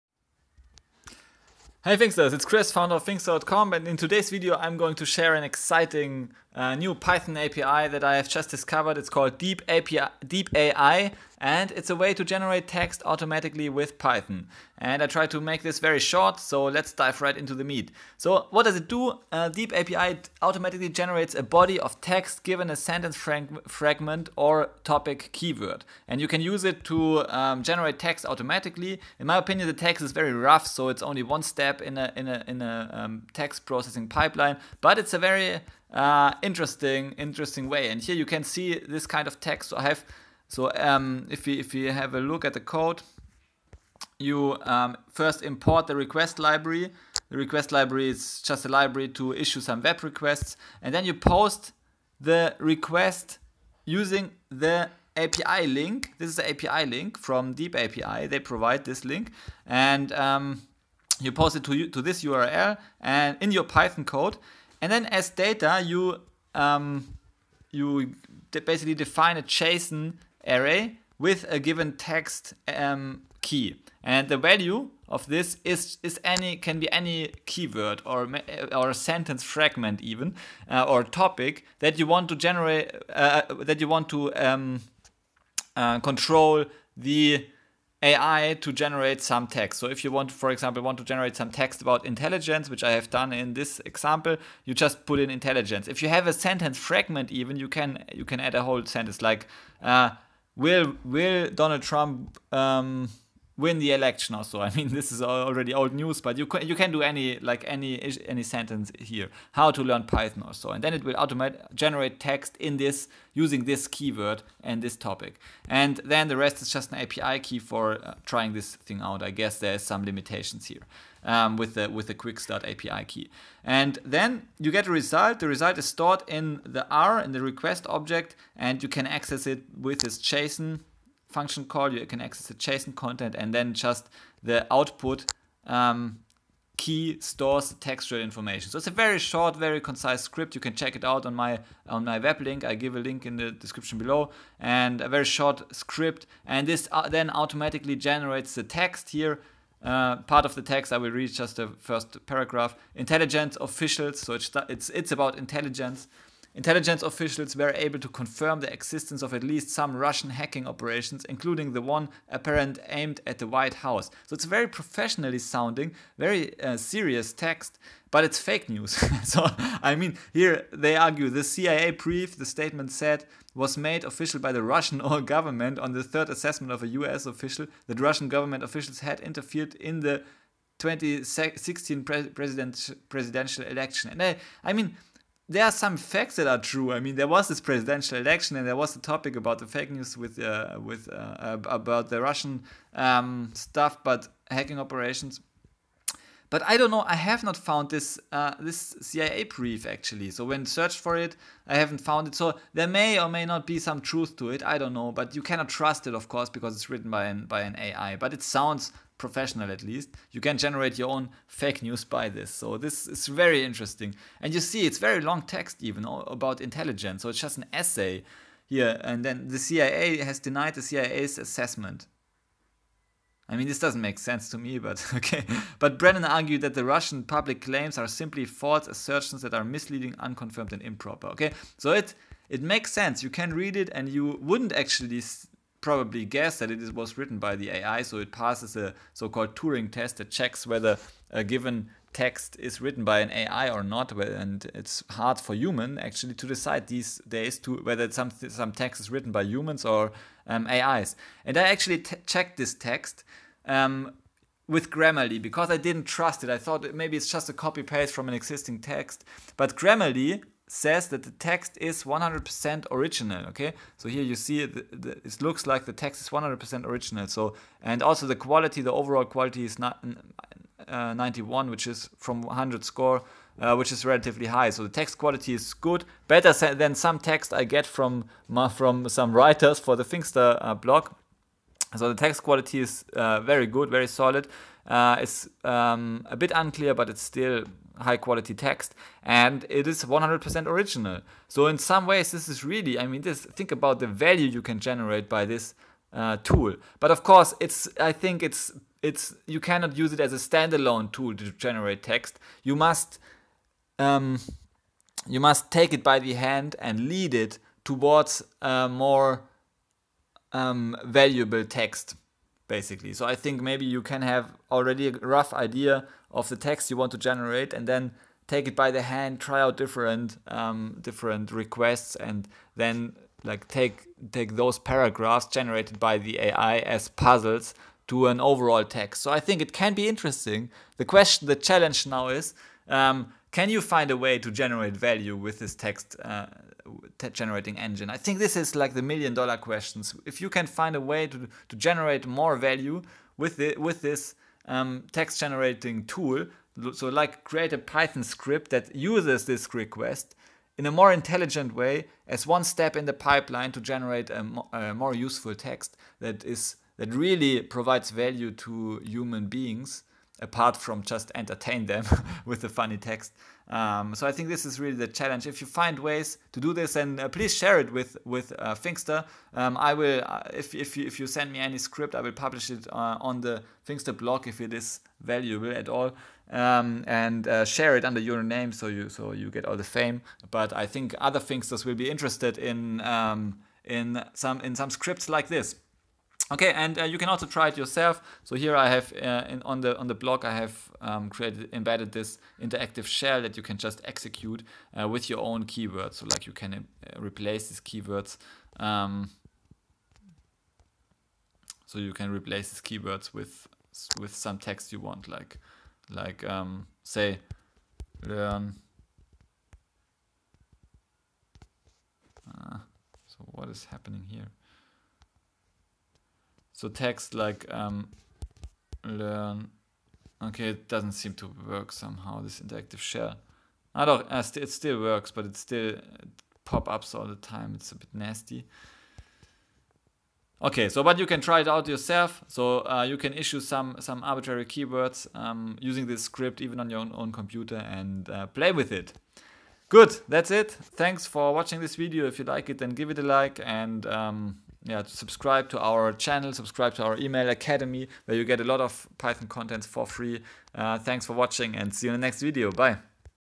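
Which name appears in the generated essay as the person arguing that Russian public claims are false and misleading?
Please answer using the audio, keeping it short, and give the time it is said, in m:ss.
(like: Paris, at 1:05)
Brennan, at 3:45.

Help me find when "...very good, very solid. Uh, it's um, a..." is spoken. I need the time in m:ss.
4:43.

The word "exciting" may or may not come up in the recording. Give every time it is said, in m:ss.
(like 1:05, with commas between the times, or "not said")
0:05.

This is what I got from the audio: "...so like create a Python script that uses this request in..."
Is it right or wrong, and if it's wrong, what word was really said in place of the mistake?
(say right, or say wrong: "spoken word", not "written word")
right.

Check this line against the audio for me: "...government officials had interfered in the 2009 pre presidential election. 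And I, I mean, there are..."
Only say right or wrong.
wrong.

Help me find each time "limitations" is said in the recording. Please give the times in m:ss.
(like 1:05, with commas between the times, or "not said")
2:00.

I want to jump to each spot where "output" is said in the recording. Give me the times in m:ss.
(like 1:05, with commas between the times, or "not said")
2:14.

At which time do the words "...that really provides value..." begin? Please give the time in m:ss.
5:57.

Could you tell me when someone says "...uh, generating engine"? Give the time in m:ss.
5:36.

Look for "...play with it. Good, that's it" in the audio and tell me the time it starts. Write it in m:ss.
7:18.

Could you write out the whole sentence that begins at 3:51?
Okay, so it it makes sense.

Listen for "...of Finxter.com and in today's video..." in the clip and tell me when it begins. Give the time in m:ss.
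0:02.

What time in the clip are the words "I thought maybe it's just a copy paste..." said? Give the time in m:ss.
4:16.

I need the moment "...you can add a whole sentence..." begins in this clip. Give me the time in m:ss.
1:38.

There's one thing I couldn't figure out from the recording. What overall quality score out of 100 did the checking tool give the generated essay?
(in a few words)
91.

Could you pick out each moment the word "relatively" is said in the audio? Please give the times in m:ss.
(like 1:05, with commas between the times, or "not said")
4:34.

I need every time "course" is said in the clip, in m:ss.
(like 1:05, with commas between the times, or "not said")
3:26, 4:57.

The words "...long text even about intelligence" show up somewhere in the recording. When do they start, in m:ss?
3:35.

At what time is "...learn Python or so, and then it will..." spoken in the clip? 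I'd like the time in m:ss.
1:49.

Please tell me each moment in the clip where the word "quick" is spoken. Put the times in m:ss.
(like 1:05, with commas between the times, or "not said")
2:02.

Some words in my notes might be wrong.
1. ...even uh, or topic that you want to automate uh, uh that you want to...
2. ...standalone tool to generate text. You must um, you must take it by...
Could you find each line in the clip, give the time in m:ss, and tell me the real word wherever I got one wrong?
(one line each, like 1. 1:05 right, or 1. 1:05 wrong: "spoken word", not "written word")
1. 1:20 wrong: "generate", not "automate"
2. 5:00 right.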